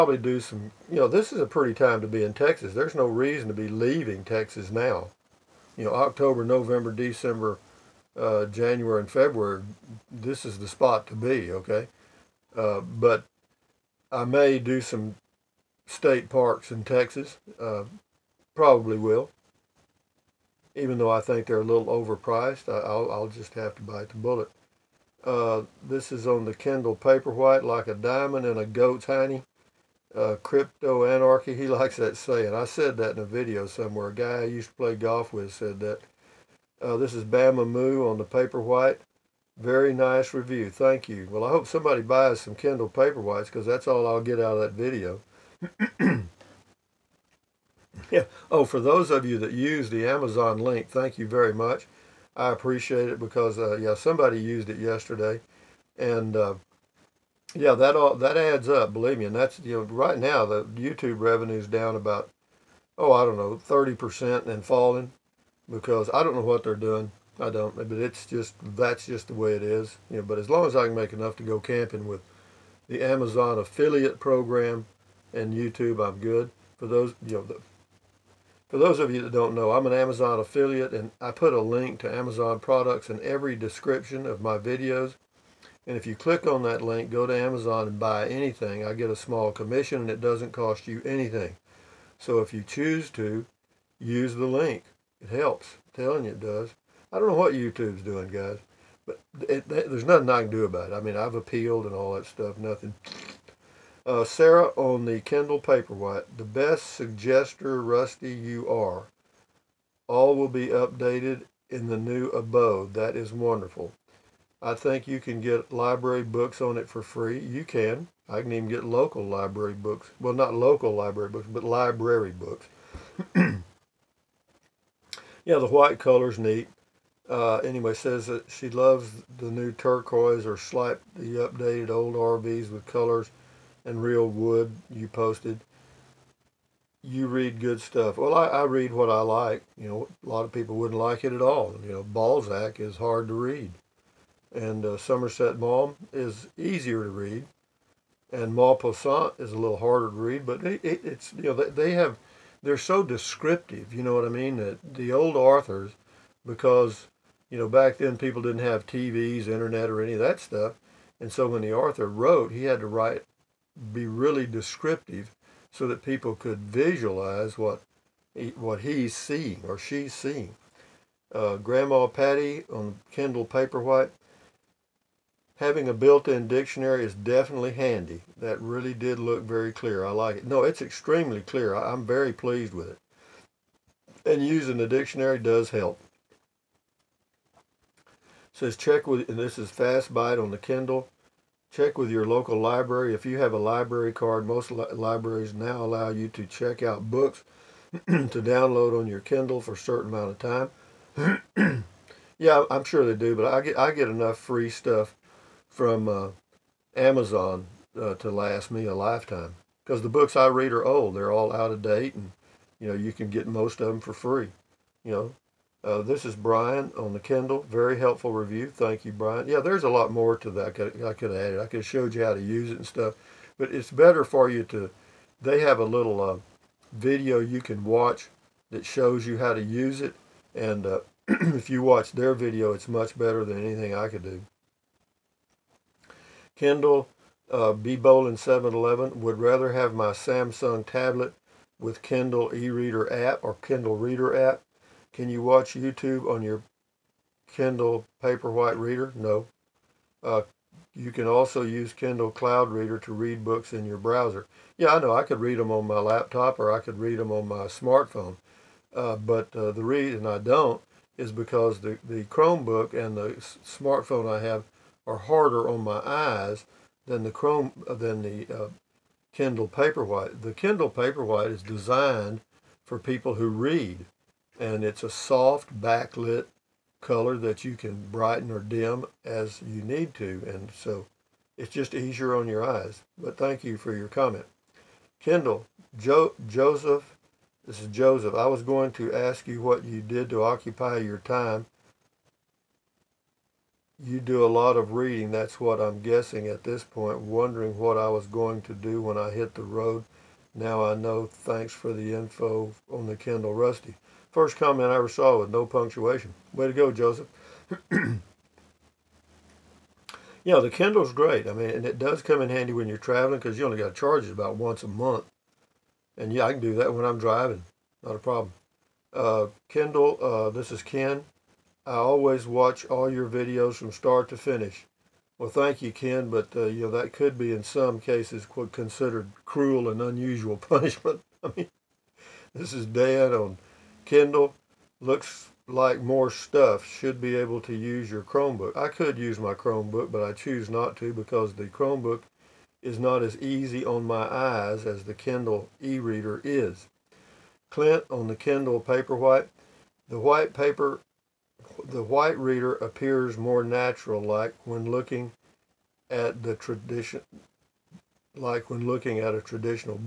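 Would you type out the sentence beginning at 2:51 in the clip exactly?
Uh, Grandma Patty on Kindle Paperwhite.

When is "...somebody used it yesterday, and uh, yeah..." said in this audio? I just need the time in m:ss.
0:53.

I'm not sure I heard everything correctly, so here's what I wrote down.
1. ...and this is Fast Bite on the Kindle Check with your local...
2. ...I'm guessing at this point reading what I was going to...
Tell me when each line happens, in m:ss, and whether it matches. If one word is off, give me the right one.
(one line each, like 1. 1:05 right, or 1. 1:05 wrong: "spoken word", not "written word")
1. 3:09 right
2. 4:55 wrong: "wondering", not "reading".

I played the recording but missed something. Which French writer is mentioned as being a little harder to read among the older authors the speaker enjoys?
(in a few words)
Maupassant.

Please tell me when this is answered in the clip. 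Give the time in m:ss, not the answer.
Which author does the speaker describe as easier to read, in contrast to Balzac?
2:24.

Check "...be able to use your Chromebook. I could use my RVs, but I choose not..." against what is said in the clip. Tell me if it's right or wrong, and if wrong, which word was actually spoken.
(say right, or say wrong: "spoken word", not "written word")
wrong: "Chromebook", not "RVs".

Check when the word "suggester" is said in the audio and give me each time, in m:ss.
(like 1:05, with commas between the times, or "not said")
1:46.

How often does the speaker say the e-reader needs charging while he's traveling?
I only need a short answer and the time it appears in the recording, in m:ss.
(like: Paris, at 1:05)
About once a month, at 5:14.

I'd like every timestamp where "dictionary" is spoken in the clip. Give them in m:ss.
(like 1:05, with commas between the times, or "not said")
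2:56, 3:04.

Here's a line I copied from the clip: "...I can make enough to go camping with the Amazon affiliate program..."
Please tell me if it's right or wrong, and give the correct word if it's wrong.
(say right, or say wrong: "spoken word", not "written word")
right.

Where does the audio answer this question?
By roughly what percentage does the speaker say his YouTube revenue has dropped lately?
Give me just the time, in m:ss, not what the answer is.
1:03.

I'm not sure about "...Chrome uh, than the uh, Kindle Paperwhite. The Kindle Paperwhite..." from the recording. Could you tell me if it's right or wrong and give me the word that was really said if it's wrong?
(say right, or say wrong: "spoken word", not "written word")
right.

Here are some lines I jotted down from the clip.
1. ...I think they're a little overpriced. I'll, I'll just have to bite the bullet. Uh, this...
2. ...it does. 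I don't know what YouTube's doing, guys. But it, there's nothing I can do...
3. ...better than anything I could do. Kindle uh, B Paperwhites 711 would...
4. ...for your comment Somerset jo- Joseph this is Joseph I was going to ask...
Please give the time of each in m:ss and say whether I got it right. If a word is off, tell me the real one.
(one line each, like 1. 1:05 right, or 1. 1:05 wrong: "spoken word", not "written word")
1. 0:21 right
2. 1:36 right
3. 3:53 wrong: "Bowling", not "Paperwhites"
4. 4:43 wrong: "Kendall", not "Somerset".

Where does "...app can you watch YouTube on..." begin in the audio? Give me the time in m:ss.
4:04.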